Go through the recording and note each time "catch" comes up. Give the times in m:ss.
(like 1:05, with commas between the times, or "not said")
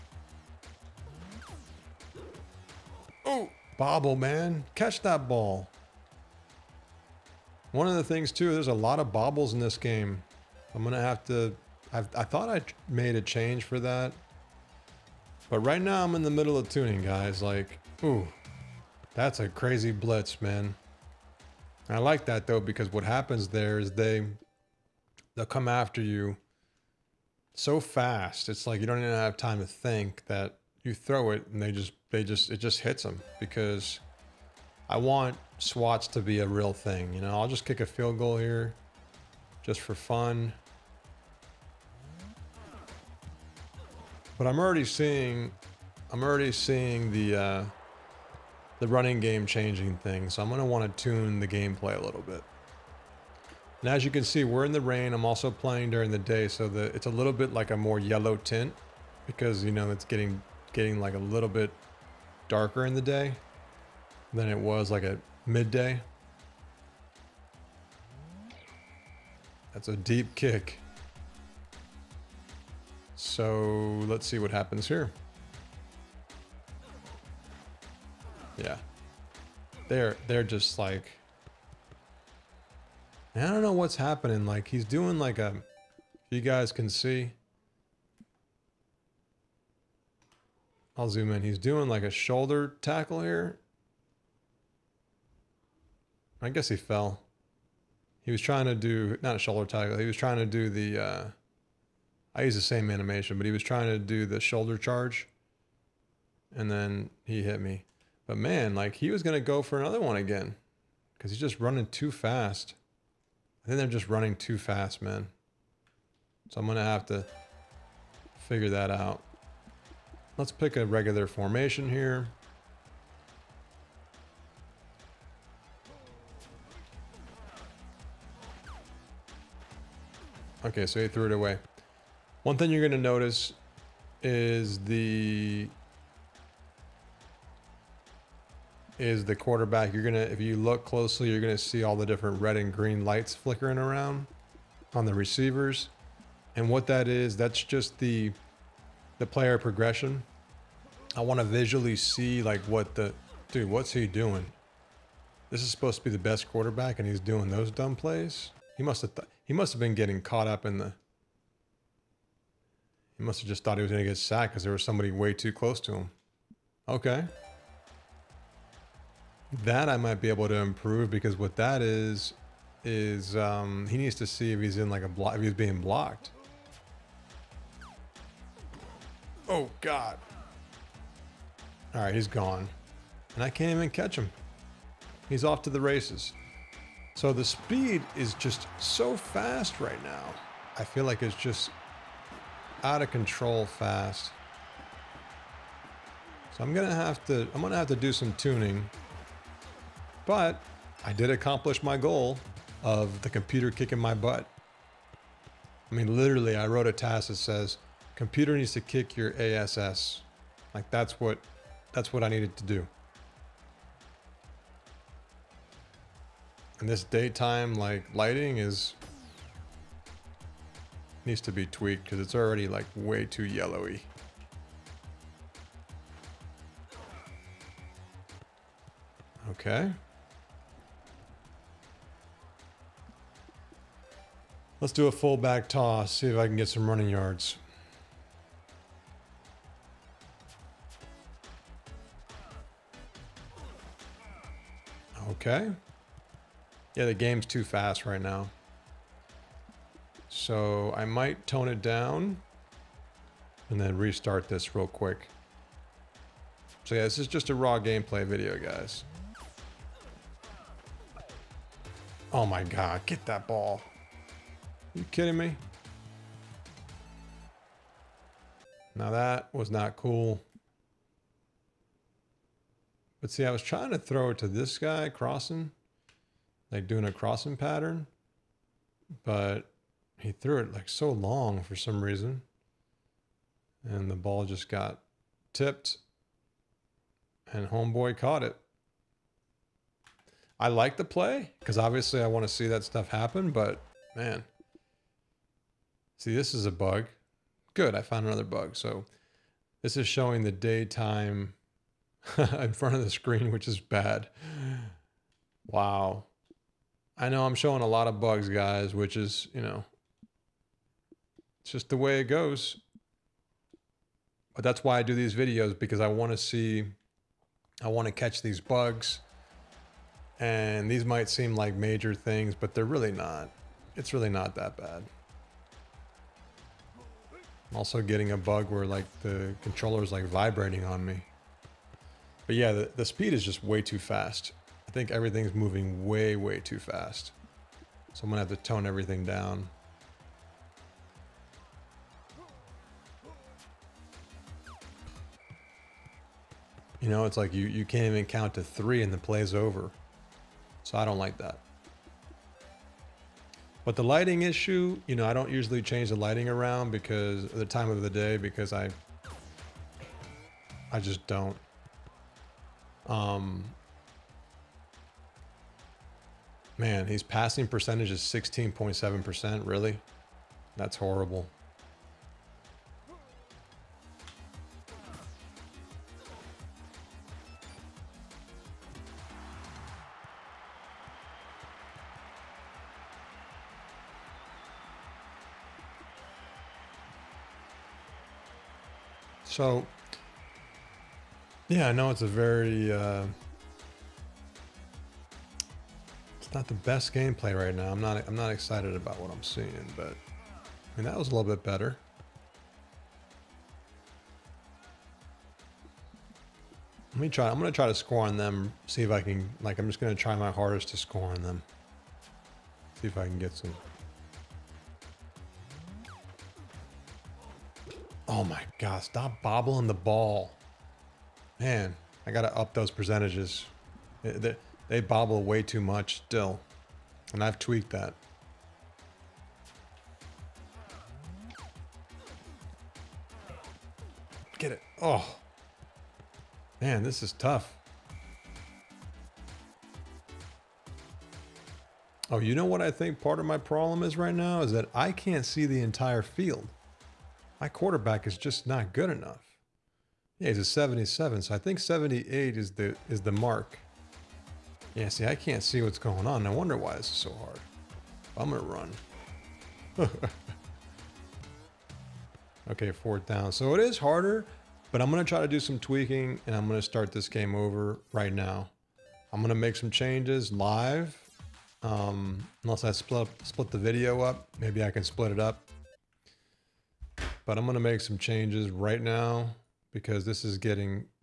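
0:04, 3:03, 5:18.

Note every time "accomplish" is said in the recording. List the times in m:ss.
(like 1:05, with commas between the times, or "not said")
3:21.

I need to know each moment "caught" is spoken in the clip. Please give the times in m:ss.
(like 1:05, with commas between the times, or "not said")
2:40, 4:48.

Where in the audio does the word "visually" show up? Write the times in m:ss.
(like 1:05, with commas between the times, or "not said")
2:31.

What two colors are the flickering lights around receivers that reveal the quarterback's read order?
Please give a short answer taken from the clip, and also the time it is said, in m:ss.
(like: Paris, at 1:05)
Red and green, at 2:22.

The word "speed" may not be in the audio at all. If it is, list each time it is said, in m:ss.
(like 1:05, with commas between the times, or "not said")
3:07, 5:33.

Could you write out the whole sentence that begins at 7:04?
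They, they bobble way too much still.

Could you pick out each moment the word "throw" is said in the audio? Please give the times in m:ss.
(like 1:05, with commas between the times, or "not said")
0:30, 4:33.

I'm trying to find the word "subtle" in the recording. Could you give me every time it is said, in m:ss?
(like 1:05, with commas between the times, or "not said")
not said.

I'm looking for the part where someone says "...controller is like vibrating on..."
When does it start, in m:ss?
5:29.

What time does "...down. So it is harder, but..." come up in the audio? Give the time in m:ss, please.
7:43.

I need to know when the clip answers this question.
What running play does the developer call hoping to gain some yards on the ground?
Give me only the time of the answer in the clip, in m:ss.
3:55.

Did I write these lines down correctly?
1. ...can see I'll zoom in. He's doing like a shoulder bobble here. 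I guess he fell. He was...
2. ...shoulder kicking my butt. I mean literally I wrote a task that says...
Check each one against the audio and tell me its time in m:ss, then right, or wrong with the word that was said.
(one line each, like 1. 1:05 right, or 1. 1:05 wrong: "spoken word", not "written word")
1. 1:26 wrong: "tackle", not "bobble"
2. 3:23 wrong: "computer", not "shoulder".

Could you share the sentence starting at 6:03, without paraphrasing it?
Um, man, his passing percentage is 16.7%.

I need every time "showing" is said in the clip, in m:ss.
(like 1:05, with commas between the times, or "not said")
5:00, 5:07.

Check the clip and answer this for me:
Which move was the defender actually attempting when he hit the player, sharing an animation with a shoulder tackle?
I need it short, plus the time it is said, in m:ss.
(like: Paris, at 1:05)
Shoulder charge, at 1:44.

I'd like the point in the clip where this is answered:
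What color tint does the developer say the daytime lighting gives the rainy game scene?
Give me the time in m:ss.
0:57.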